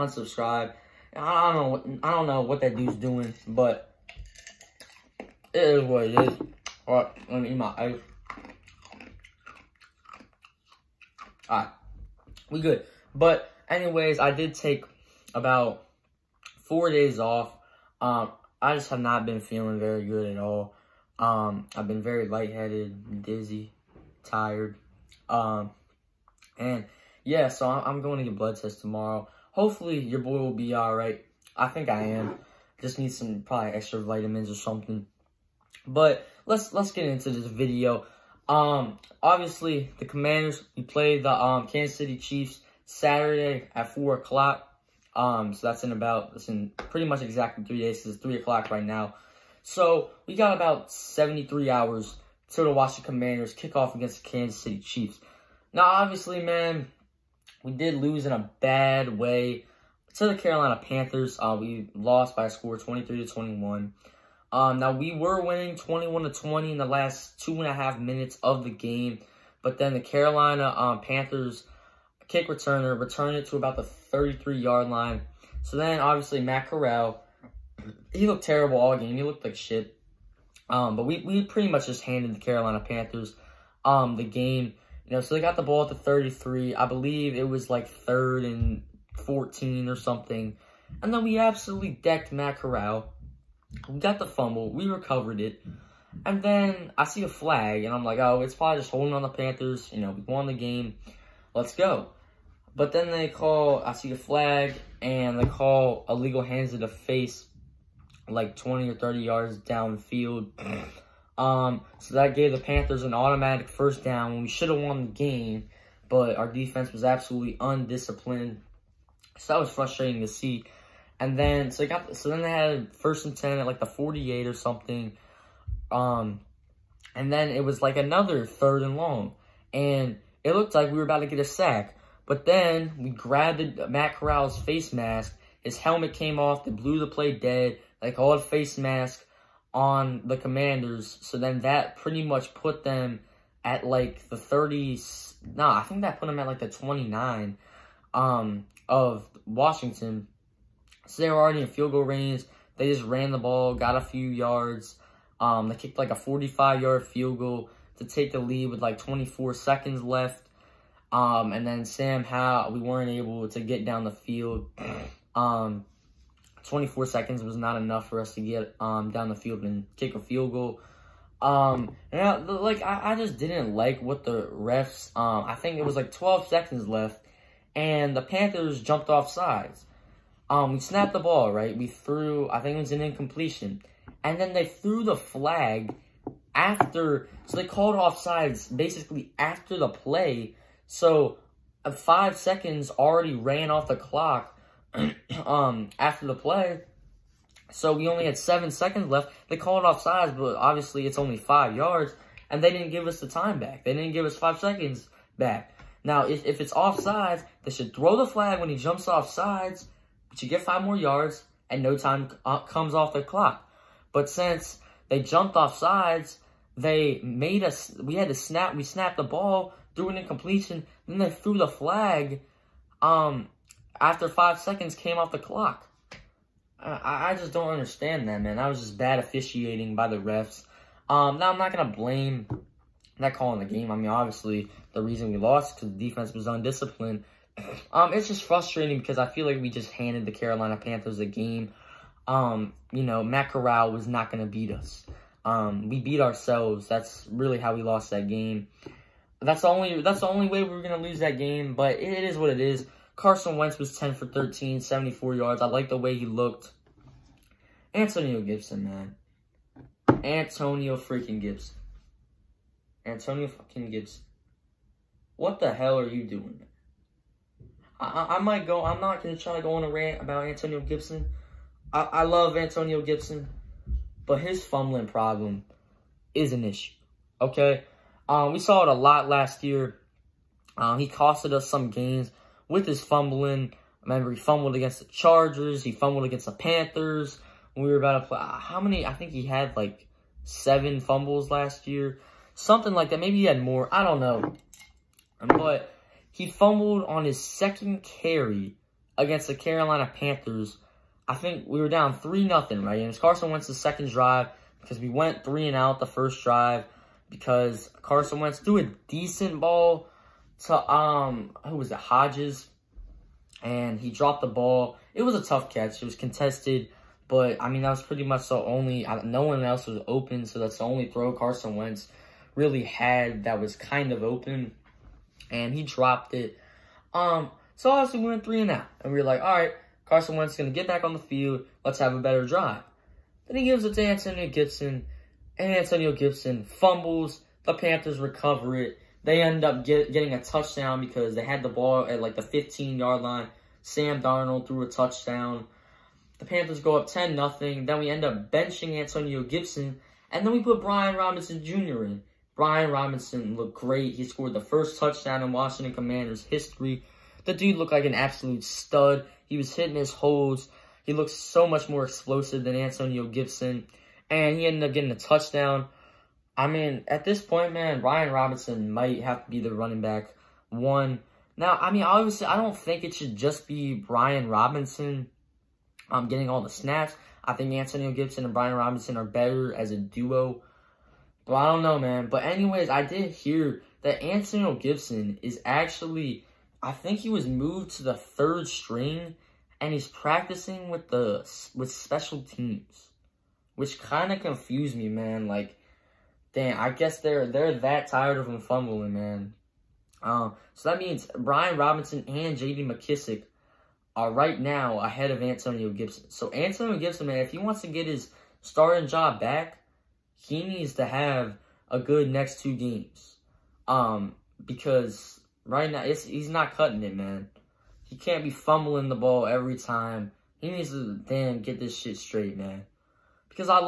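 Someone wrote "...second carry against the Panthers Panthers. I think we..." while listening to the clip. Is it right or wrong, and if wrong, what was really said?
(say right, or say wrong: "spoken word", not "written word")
wrong: "Carolina", not "Panthers".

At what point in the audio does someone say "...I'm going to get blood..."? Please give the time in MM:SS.
00:27.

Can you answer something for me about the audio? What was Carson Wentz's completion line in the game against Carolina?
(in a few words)
10 for 13.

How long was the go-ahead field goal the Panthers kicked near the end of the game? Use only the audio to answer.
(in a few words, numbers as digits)
45 yards.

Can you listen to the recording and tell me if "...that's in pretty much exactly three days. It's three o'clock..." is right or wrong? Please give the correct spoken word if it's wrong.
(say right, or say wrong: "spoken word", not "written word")
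right.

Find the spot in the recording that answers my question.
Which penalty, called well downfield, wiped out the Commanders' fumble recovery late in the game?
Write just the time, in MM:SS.
01:46.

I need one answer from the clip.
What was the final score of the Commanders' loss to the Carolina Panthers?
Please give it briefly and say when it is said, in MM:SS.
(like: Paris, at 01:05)
23 to 21, at 01:02.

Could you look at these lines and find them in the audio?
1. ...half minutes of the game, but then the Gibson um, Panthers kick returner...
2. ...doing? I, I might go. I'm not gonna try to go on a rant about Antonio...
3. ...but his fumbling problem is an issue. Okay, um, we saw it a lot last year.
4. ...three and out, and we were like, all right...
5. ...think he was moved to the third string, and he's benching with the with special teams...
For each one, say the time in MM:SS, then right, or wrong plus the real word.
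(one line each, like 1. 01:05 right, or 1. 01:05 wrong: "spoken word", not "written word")
1. 01:07 wrong: "Carolina", not "Gibson"
2. 04:26 right
3. 04:34 right
4. 05:28 right
5. 06:26 wrong: "practicing", not "benching".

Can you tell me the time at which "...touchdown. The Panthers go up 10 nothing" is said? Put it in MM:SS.
05:44.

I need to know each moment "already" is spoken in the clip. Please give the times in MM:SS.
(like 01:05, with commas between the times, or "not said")
02:31, 03:12.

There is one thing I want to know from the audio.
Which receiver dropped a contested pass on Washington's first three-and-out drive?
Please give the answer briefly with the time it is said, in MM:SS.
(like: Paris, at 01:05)
Hodges, at 05:11.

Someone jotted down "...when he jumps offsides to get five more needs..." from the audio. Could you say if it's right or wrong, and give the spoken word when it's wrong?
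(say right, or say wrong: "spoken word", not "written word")
wrong: "yards", not "needs".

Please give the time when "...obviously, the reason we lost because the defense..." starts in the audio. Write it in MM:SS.
03:54.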